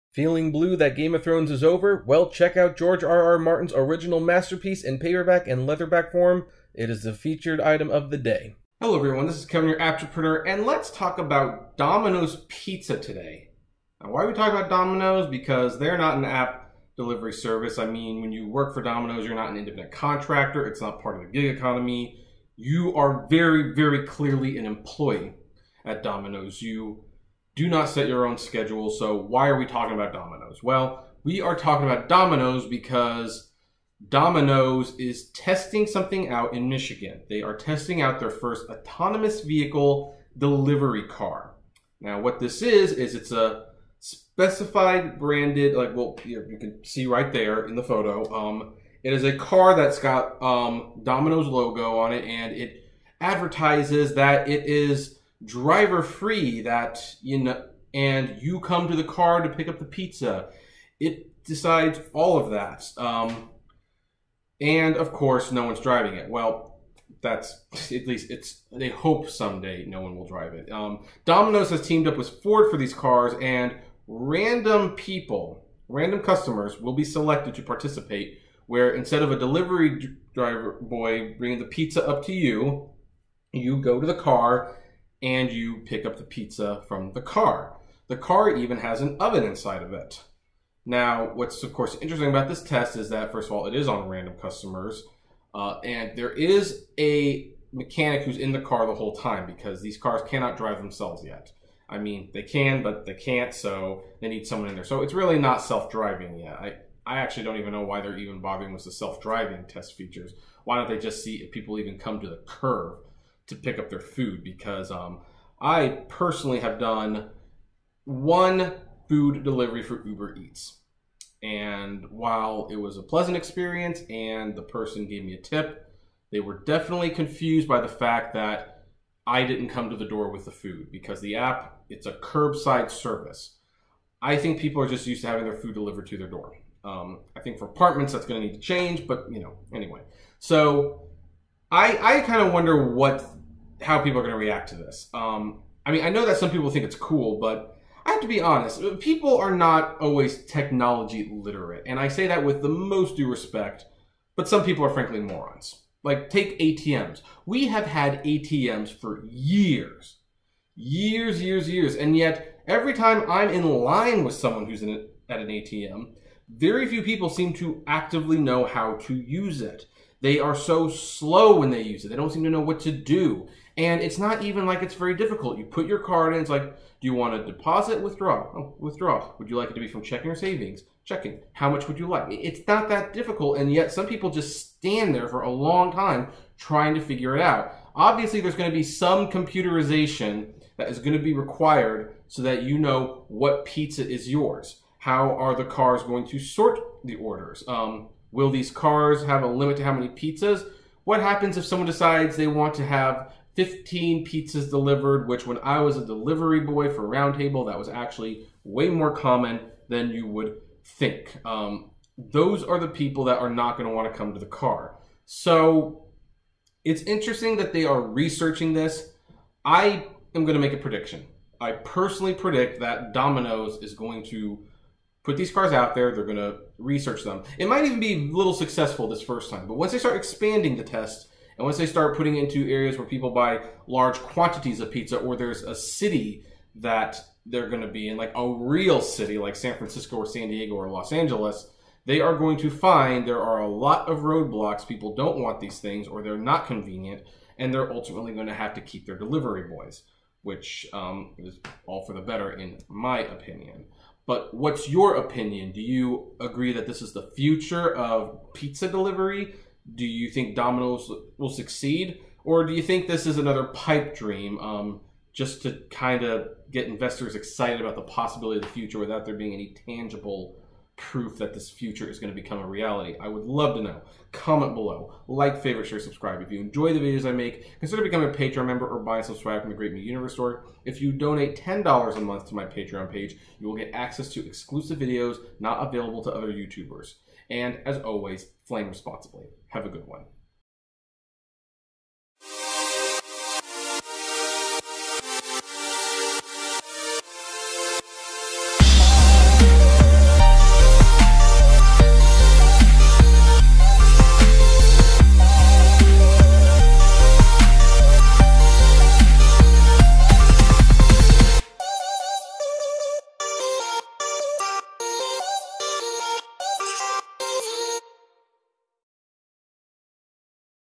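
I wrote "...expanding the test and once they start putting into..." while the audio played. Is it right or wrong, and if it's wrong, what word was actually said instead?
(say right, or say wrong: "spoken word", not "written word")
right.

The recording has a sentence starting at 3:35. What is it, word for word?
So it's interesting that they are researching this.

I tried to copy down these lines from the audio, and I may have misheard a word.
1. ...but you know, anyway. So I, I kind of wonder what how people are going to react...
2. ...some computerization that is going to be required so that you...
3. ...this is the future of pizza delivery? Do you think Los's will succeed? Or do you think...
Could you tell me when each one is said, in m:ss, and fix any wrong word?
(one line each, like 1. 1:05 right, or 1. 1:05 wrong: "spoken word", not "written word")
1. 2:19 right
2. 3:08 right
3. 4:16 wrong: "Domino", not "Los".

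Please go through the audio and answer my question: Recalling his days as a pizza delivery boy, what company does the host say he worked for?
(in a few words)
Roundtable.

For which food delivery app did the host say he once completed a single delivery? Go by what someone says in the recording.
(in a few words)
Uber Eats.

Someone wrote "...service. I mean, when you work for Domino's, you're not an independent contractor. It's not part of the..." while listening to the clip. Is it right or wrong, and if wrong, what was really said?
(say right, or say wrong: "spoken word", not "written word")
right.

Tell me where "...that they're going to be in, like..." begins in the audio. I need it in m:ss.
3:56.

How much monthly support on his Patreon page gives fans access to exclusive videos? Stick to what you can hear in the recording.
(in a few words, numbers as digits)
$10.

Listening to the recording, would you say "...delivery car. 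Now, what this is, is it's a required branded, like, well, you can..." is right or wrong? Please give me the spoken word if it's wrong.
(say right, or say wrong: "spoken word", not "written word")
wrong: "specified", not "required".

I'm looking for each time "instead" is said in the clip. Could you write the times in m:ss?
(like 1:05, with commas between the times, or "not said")
1:18.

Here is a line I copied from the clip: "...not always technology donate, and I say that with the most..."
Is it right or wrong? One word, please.
wrong.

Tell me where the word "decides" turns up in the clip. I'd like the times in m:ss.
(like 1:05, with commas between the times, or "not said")
1:01, 3:21.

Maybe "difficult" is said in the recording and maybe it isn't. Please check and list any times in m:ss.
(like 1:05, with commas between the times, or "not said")
2:55, 3:03.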